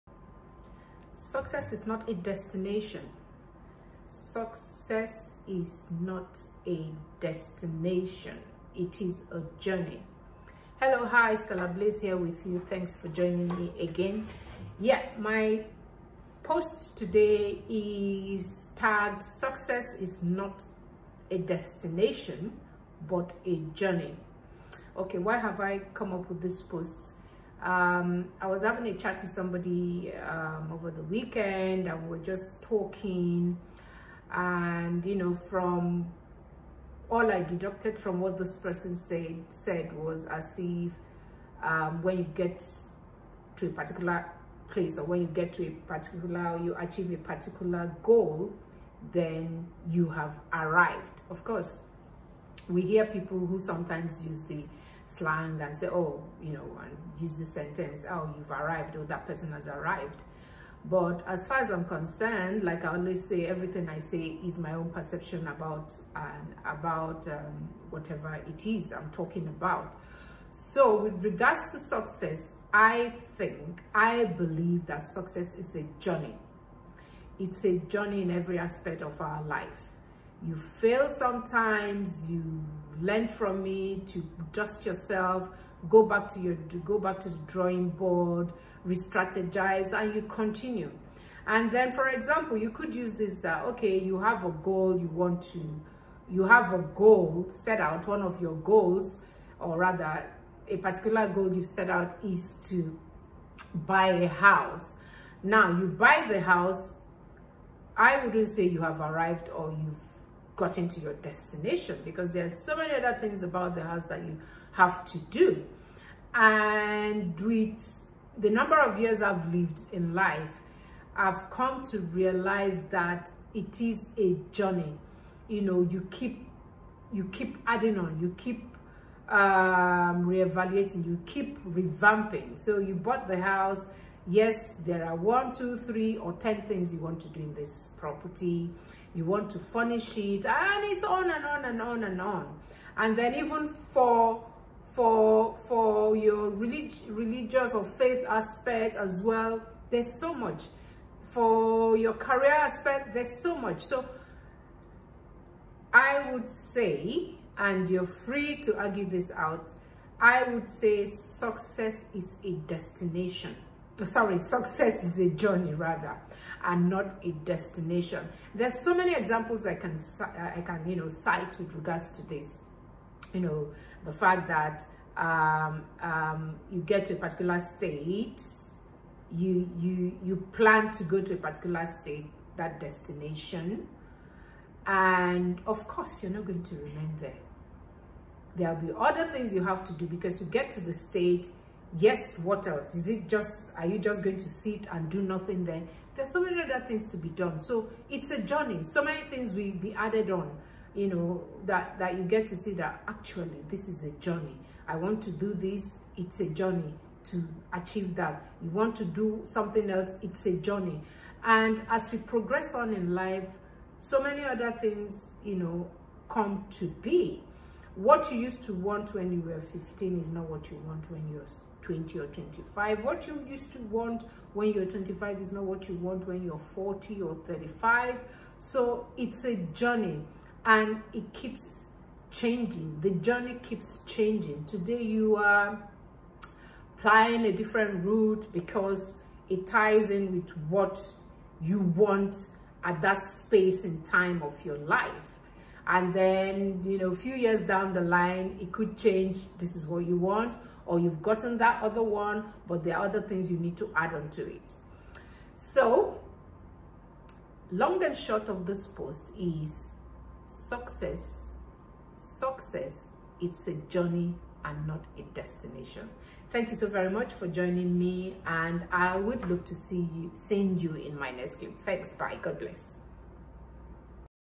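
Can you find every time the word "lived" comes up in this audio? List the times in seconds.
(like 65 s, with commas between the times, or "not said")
119 s.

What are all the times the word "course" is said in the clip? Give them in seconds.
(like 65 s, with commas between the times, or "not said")
51 s, 185 s.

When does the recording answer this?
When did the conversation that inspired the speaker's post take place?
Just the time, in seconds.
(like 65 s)
30 s.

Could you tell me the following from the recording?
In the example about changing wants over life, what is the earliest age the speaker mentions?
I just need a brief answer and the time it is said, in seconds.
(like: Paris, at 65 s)
15, at 219 s.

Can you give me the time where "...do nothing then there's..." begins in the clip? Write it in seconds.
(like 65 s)
195 s.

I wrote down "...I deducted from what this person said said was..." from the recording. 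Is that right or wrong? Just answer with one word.
right.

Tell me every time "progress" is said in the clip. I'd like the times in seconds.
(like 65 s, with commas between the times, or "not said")
212 s.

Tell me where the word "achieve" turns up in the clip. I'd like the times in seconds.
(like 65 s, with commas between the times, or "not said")
46 s, 207 s.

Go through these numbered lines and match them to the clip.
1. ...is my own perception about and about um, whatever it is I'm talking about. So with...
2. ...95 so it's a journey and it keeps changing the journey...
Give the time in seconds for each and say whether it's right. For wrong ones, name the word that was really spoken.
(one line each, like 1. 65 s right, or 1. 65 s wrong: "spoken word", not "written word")
1. 64 s right
2. 227 s wrong: "35", not "95".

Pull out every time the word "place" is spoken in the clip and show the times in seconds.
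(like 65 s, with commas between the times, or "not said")
44 s.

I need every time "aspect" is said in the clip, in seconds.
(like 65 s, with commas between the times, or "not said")
78 s, 148 s, 152 s.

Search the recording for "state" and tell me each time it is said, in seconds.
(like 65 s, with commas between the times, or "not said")
177 s, 181 s, 190 s.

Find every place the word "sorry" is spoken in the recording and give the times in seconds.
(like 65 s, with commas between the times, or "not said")
164 s.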